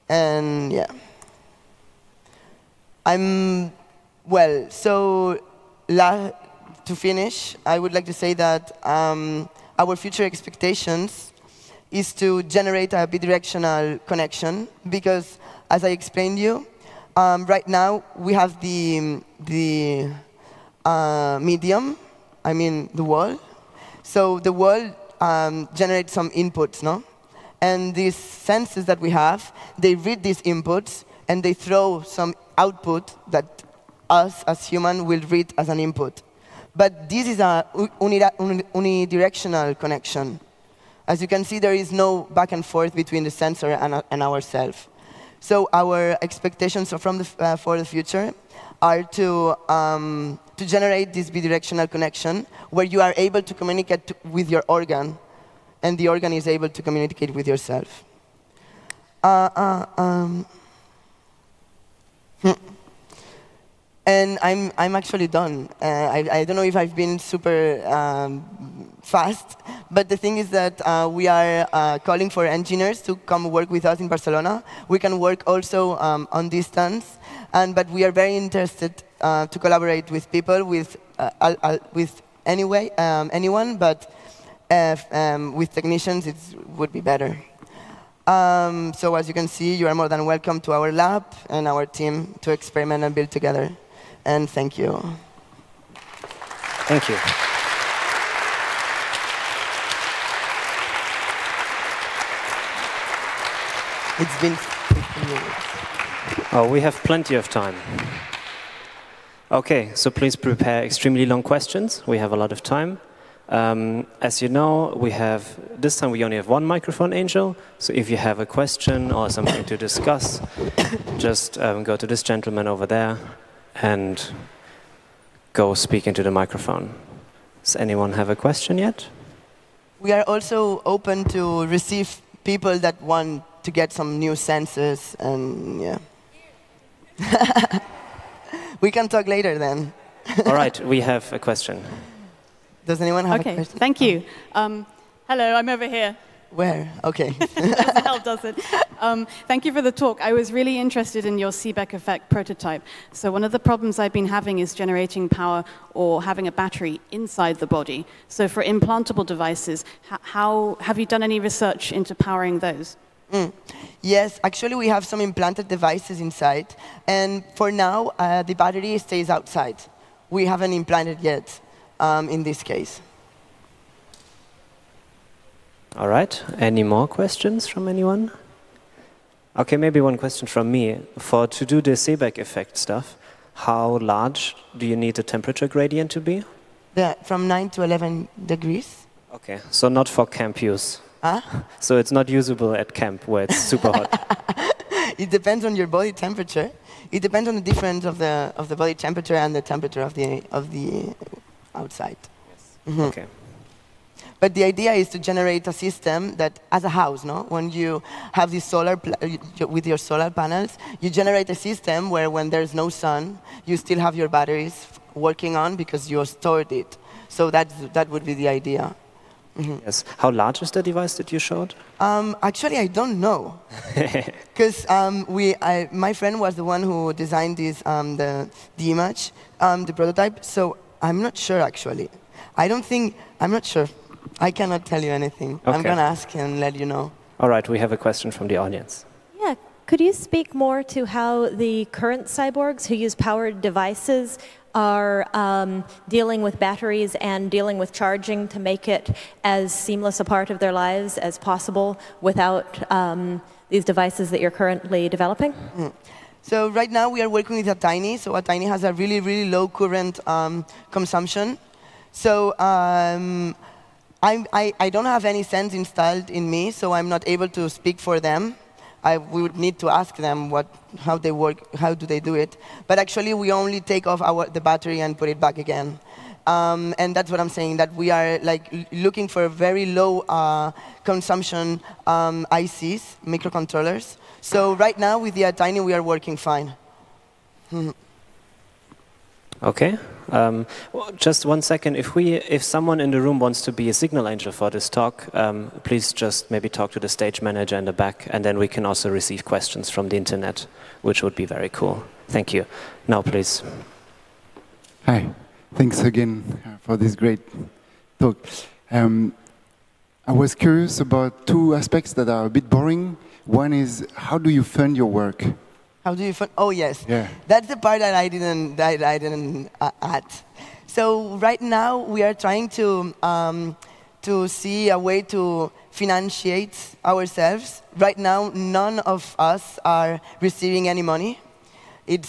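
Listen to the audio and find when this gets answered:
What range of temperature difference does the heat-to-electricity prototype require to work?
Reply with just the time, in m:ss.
3:07.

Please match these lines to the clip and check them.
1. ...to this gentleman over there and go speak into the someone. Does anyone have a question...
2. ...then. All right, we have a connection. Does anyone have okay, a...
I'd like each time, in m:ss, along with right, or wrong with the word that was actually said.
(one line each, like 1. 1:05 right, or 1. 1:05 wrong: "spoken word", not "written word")
1. 2:01 wrong: "microphone", not "someone"
2. 2:19 wrong: "question", not "connection".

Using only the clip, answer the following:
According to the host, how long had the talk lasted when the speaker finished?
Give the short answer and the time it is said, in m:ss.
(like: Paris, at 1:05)
15 minutes, at 1:44.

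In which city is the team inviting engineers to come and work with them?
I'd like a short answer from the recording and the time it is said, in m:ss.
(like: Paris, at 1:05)
Barcelona, at 1:14.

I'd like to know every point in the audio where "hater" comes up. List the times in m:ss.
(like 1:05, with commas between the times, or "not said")
not said.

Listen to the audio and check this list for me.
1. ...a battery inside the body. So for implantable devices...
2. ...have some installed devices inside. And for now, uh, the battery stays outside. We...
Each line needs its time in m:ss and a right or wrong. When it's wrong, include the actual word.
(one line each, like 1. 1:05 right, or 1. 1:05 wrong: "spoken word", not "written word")
1. 2:36 right
2. 2:44 wrong: "implanted", not "installed".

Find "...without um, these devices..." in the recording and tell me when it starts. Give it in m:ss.
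4:12.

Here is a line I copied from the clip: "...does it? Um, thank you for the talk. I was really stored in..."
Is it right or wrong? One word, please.
wrong.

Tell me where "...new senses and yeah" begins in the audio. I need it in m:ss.
2:14.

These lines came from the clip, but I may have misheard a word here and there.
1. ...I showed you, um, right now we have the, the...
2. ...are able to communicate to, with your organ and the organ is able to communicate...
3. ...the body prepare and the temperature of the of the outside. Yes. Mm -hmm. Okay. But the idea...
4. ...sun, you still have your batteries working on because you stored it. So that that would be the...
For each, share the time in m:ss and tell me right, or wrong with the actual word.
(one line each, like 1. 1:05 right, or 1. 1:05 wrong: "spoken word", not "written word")
1. 0:15 wrong: "explained", not "showed"
2. 0:53 right
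3. 3:18 wrong: "temperature", not "prepare"
4. 3:32 right.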